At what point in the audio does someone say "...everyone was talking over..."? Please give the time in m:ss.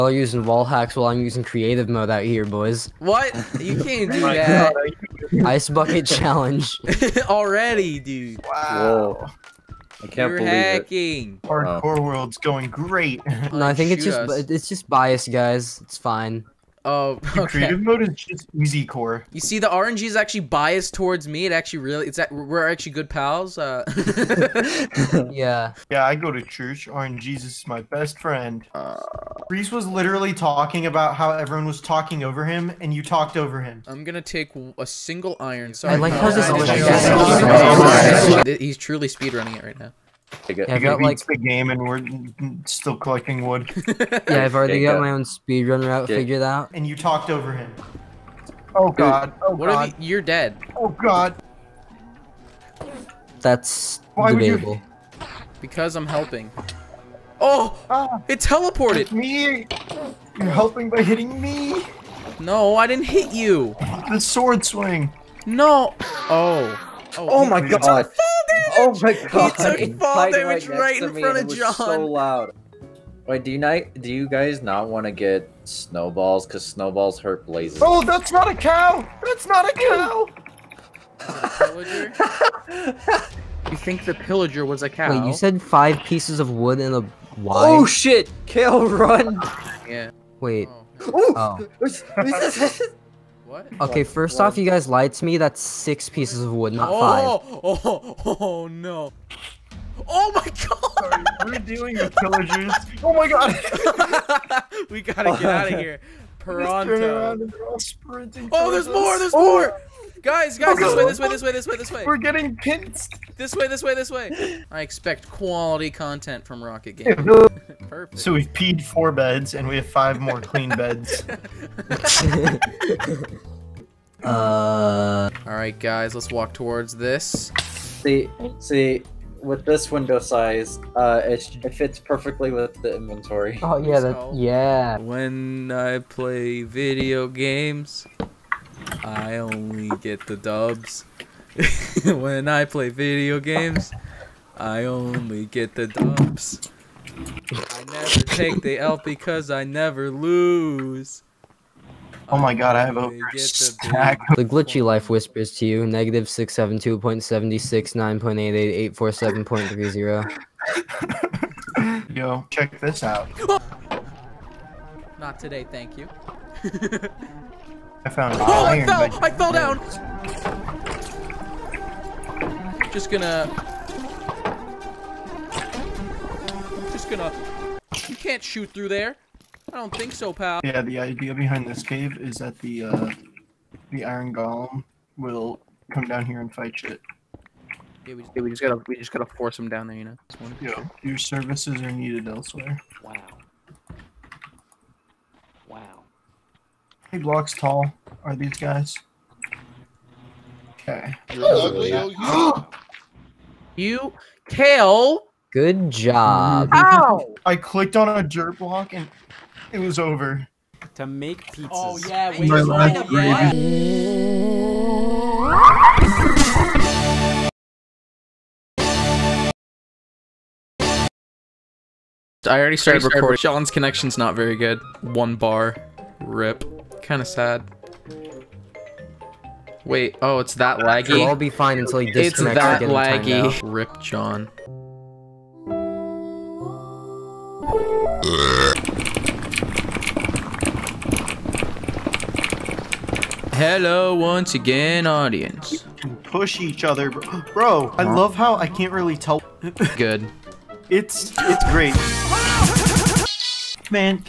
0:31.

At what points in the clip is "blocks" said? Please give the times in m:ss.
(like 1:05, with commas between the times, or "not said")
3:17, 3:28.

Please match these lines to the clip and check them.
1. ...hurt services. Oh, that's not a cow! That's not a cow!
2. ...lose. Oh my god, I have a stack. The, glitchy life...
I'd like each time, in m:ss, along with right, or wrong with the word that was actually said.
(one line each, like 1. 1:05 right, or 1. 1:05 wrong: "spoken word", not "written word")
1. 1:17 wrong: "blazes", not "services"
2. 2:30 right.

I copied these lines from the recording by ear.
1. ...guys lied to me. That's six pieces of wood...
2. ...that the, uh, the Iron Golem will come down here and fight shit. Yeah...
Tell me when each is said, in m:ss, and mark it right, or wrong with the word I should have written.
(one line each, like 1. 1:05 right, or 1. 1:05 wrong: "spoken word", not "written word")
1. 1:34 right
2. 3:02 right.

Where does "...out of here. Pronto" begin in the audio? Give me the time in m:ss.
1:45.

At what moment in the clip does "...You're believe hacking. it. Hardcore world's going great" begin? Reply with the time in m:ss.
0:10.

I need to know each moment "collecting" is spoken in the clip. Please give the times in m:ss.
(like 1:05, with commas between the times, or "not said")
0:42.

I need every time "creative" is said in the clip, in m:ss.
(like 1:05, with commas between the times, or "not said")
0:01, 0:17.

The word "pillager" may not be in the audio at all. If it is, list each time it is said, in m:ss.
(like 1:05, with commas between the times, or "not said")
1:24, 1:42.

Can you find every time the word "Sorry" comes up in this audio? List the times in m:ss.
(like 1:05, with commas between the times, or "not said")
0:35, 1:40.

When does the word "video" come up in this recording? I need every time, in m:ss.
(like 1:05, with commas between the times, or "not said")
2:16, 2:22.